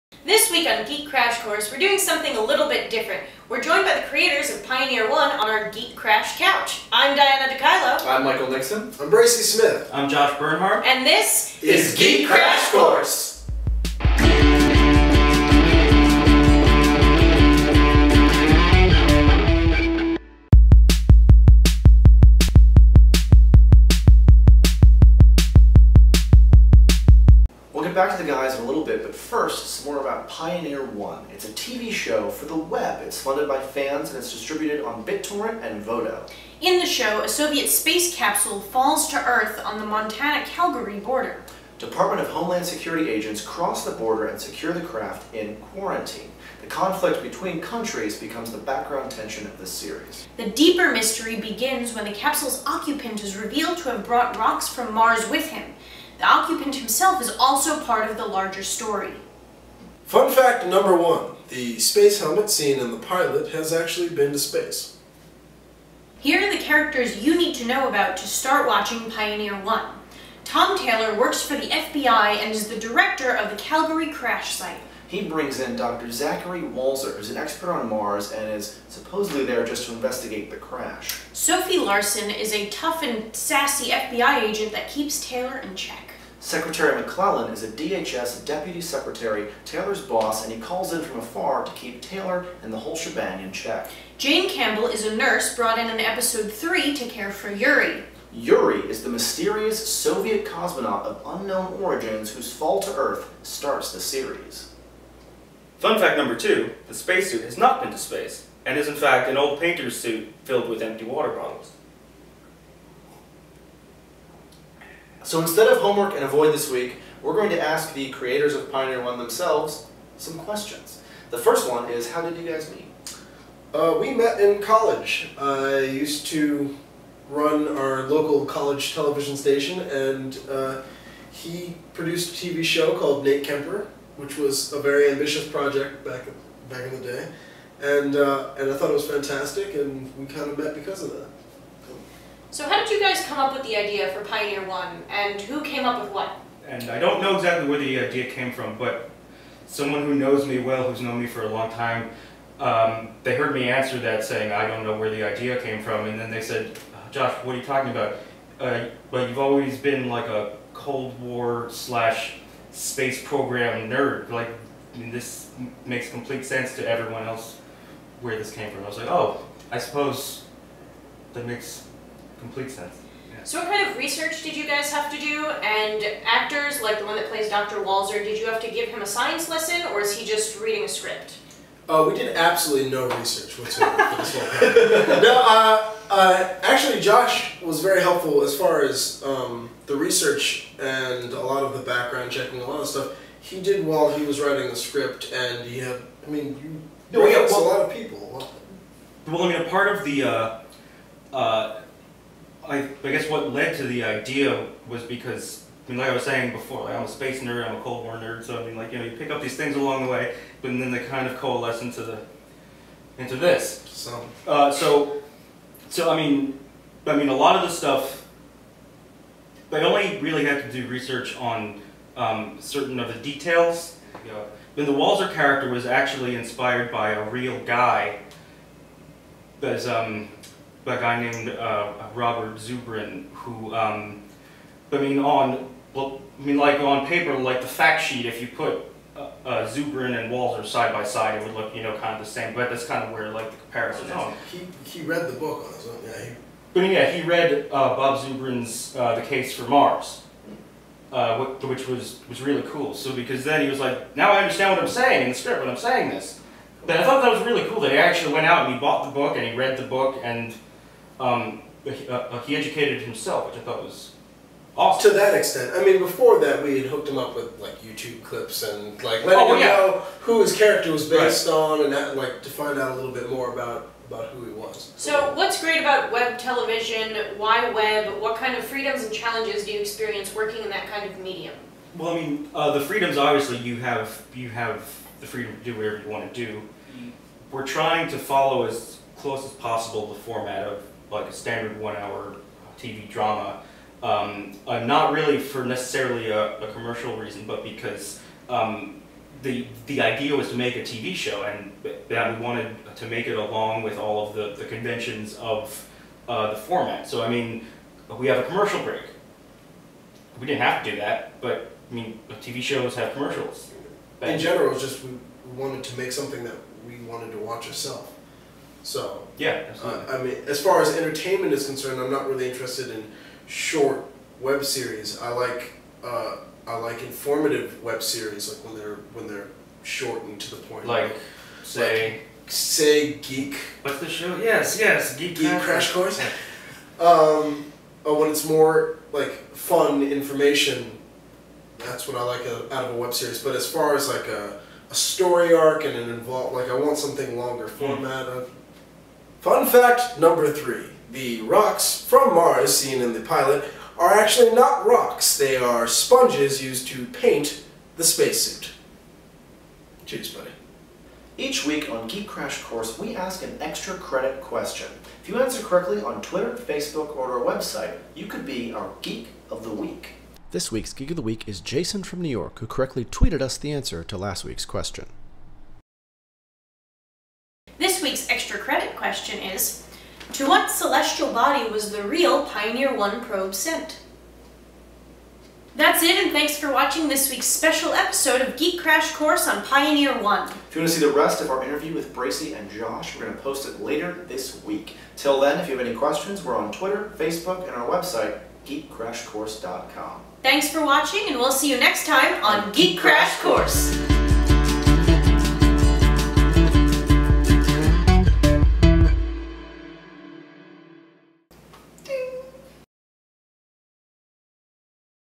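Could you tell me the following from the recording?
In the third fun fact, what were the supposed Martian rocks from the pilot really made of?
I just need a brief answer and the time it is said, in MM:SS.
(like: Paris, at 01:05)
Sponges, at 05:55.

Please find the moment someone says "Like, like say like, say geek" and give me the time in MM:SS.
05:30.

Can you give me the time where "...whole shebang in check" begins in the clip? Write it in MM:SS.
01:32.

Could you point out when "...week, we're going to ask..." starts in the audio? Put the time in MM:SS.
01:56.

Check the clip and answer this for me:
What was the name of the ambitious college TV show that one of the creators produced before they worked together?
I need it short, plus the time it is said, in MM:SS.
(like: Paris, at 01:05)
Nate Kemper, at 02:13.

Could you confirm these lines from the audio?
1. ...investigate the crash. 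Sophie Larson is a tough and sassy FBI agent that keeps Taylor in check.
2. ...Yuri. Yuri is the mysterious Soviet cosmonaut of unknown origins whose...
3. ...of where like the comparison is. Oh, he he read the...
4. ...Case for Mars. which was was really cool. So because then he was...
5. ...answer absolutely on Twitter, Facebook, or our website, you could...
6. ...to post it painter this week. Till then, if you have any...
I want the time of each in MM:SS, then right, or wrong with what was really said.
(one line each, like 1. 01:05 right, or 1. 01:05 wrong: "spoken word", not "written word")
1. 01:19 right
2. 01:37 right
3. 04:03 right
4. 04:09 right
5. 06:05 wrong: "correctly", not "absolutely"
6. 06:33 wrong: "later", not "painter".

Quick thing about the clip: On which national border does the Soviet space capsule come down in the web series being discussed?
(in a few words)
Montana-Calgary border.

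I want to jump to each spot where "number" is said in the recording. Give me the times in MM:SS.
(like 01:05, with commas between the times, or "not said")
01:00, 01:46, 05:50.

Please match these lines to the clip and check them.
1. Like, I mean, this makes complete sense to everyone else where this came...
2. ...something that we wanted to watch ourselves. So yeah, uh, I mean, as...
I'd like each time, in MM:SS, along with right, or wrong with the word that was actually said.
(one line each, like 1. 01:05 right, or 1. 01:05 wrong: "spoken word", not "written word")
1. 02:44 right
2. 05:16 right.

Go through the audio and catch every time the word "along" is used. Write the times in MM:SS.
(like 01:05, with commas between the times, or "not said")
03:29, 05:03.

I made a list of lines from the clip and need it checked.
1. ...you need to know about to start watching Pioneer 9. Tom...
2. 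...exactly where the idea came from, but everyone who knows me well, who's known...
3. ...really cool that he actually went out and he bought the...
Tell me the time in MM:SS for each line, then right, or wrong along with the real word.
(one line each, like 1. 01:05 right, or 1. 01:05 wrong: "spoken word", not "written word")
1. 01:07 wrong: "1", not "9"
2. 02:27 wrong: "someone", not "everyone"
3. 04:17 right.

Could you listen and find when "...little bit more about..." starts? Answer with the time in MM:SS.
04:32.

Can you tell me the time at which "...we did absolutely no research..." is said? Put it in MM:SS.
03:02.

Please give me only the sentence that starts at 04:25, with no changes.
To that extent, I mean, before that, we had hooked him up with like YouTube clips and like letting oh, him yeah.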